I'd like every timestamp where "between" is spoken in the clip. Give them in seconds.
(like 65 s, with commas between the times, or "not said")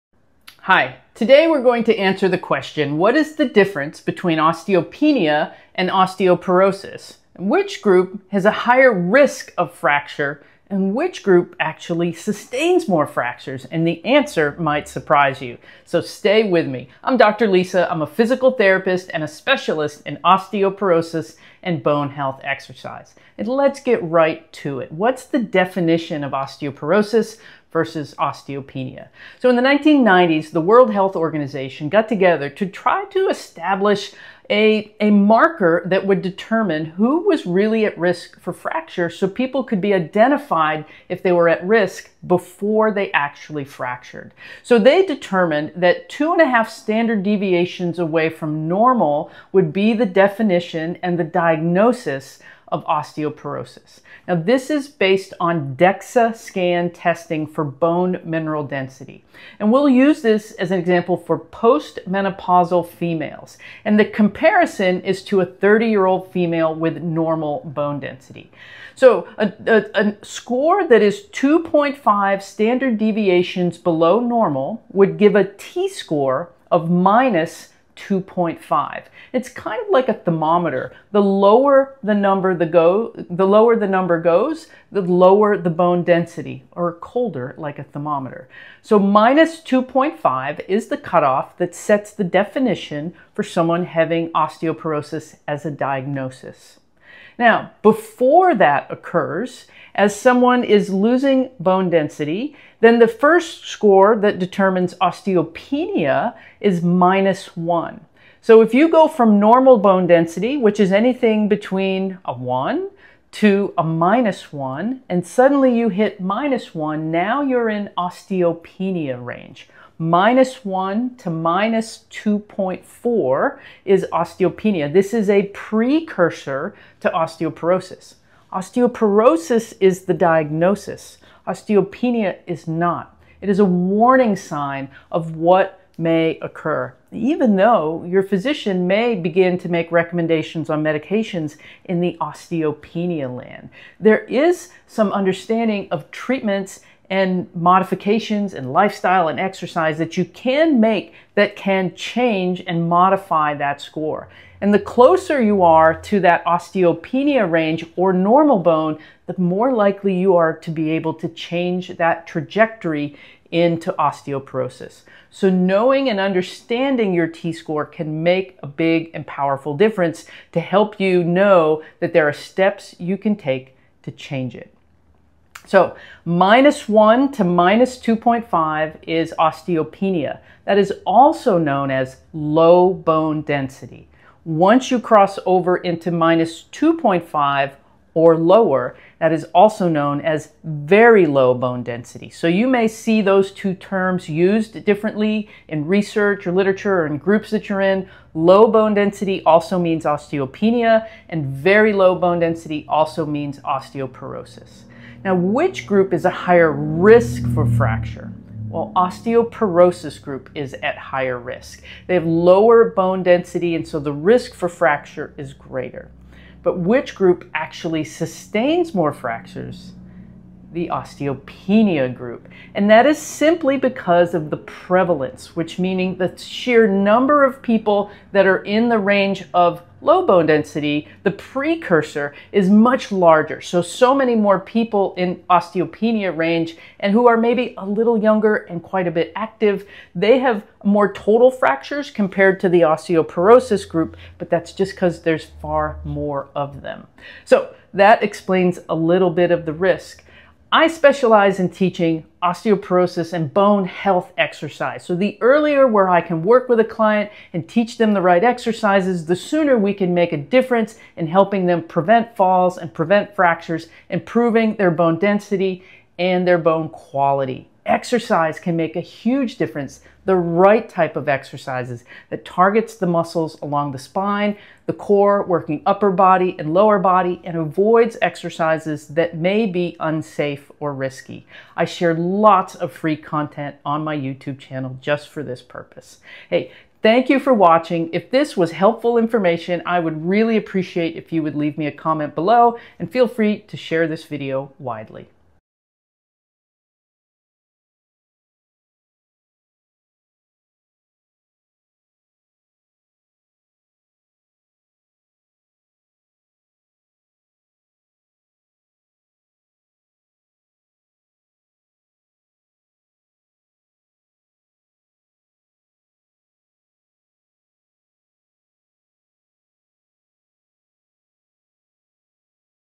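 3 s, 111 s.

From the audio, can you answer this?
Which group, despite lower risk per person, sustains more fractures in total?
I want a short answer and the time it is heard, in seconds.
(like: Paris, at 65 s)
The osteopenia group, at 220 s.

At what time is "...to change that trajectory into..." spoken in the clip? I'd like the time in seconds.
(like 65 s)
161 s.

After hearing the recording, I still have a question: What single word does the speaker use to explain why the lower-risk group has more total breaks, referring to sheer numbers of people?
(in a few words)
prevalence.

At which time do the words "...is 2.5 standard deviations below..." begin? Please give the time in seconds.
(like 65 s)
71 s.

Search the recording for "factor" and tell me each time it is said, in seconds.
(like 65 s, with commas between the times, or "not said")
not said.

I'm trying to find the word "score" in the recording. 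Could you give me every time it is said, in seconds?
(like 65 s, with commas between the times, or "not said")
70 s, 75 s, 103 s, 153 s, 167 s.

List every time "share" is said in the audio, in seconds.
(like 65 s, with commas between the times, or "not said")
281 s, 293 s.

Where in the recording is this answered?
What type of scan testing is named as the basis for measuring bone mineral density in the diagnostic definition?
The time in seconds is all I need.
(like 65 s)
55 s.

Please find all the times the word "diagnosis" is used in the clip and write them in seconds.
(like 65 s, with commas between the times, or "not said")
51 s, 95 s, 130 s.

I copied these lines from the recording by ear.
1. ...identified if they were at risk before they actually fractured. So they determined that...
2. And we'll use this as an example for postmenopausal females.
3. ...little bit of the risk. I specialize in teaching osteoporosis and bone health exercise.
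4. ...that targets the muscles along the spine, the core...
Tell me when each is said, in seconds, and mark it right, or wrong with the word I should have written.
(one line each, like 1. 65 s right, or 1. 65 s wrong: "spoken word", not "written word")
1. 39 s right
2. 59 s right
3. 248 s right
4. 272 s right.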